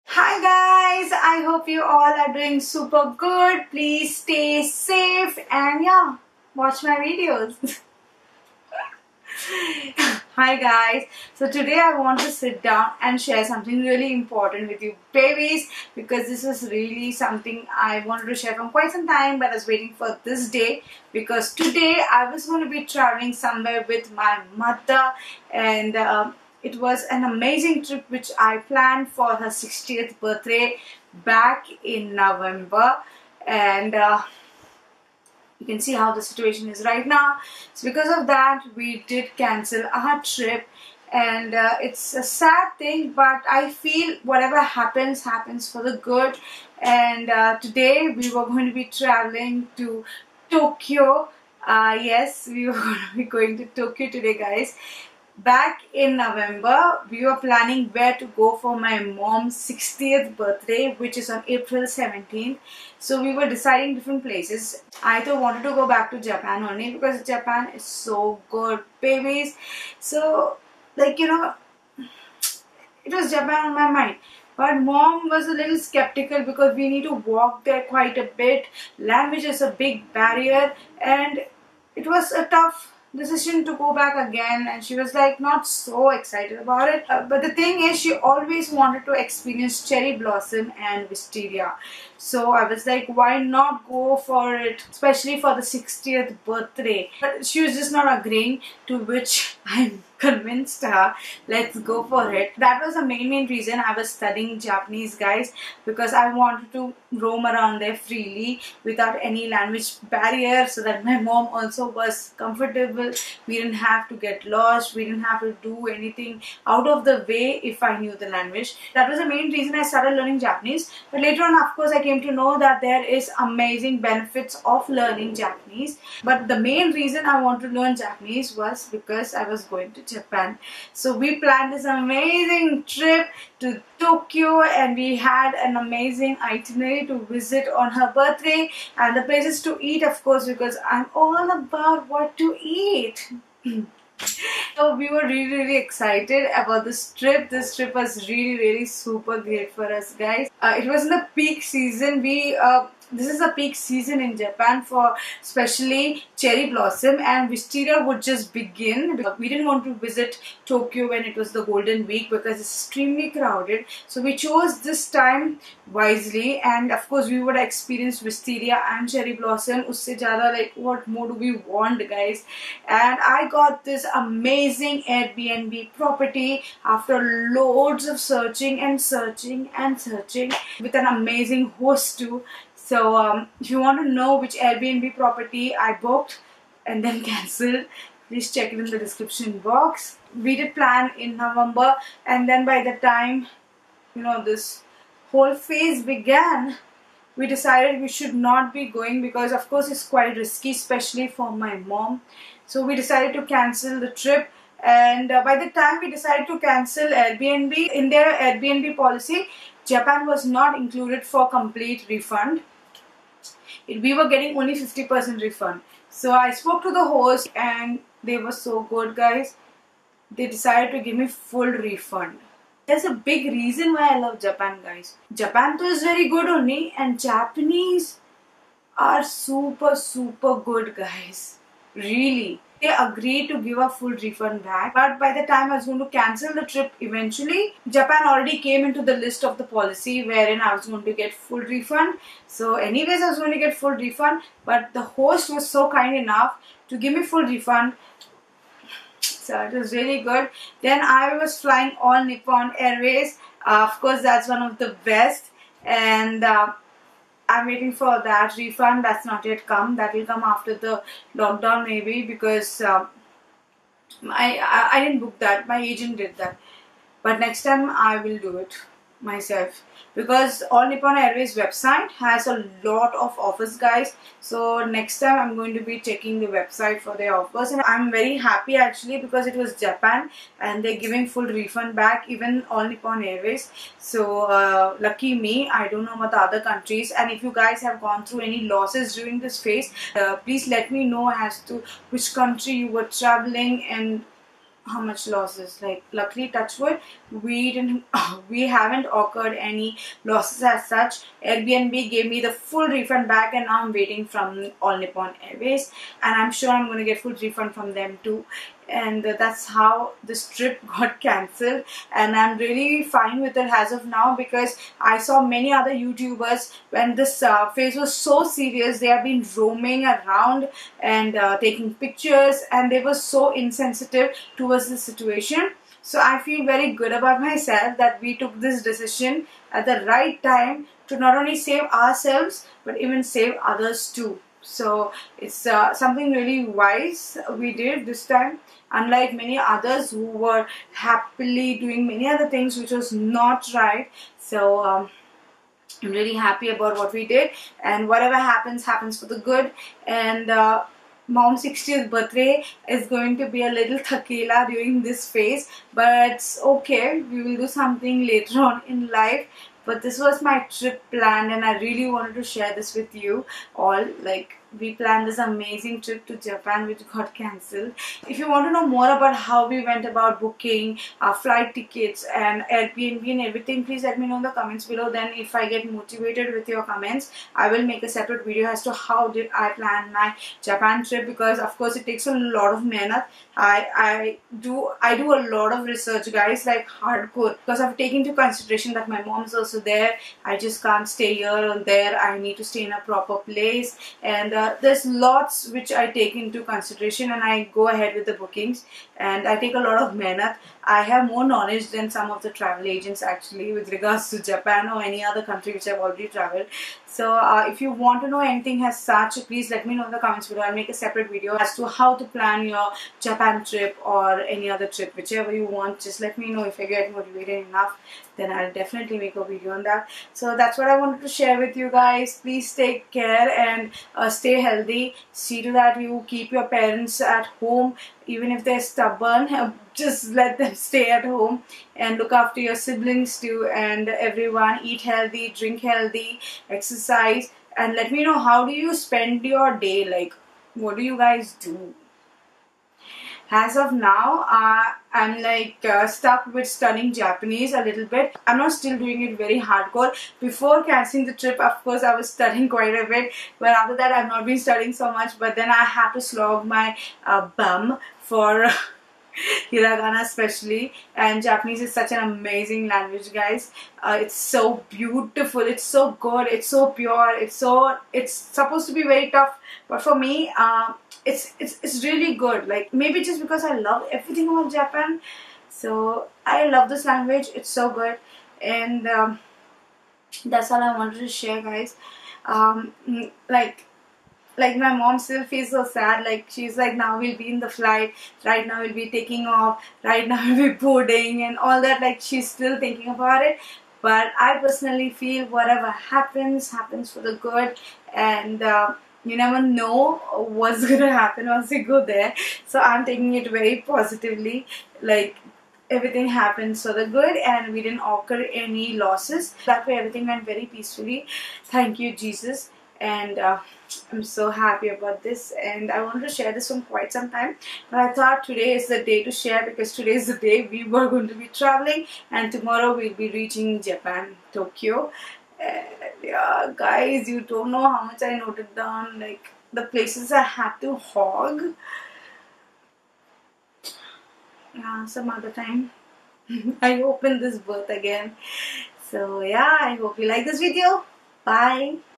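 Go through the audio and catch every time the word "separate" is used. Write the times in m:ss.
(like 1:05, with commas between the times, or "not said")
6:18, 6:50.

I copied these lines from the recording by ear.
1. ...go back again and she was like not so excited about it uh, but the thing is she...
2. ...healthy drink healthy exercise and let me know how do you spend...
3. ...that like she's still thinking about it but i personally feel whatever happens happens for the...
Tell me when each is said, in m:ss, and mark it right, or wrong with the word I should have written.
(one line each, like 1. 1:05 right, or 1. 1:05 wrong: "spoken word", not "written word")
1. 1:23 right
2. 7:15 right
3. 8:11 right.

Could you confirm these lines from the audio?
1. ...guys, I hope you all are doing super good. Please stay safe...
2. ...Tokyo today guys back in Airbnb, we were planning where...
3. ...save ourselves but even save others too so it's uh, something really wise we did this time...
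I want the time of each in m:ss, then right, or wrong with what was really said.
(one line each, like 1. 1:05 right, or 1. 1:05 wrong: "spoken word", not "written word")
1. 0:00 right
2. 0:53 wrong: "November", not "Airbnb"
3. 5:31 right.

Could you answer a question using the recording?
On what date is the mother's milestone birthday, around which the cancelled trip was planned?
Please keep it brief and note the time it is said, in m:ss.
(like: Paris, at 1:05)
April 17th, at 1:01.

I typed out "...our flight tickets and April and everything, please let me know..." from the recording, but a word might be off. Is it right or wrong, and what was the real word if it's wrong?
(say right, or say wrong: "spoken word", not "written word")
wrong: "Airbnb", not "April".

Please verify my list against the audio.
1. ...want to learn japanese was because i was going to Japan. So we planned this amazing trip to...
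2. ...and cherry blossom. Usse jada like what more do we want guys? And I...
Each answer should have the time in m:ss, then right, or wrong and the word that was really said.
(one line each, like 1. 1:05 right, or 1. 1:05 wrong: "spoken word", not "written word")
1. 2:07 right
2. 2:48 right.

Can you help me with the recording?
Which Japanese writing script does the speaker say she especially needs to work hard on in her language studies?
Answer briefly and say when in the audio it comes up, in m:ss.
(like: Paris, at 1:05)
hiragana, at 7:39.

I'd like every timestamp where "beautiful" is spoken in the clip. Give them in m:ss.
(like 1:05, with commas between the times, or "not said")
7:44.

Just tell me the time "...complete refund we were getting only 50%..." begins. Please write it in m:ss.
3:31.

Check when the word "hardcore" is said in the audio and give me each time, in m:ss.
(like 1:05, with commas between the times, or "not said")
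6:26, 7:29.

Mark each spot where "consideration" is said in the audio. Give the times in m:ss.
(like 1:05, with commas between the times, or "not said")
6:28, 6:36.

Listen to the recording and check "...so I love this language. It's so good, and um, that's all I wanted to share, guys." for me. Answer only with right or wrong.
right.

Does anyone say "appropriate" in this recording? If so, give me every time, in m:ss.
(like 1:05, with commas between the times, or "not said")
not said.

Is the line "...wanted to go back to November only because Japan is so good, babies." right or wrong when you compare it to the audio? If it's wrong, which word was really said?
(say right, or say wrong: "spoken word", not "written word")
wrong: "Japan", not "November".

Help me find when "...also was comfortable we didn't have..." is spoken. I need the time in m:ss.
1:51.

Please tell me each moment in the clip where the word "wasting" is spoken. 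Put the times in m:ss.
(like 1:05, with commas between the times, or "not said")
not said.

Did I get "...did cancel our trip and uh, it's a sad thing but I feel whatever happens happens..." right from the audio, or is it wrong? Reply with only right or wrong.
right.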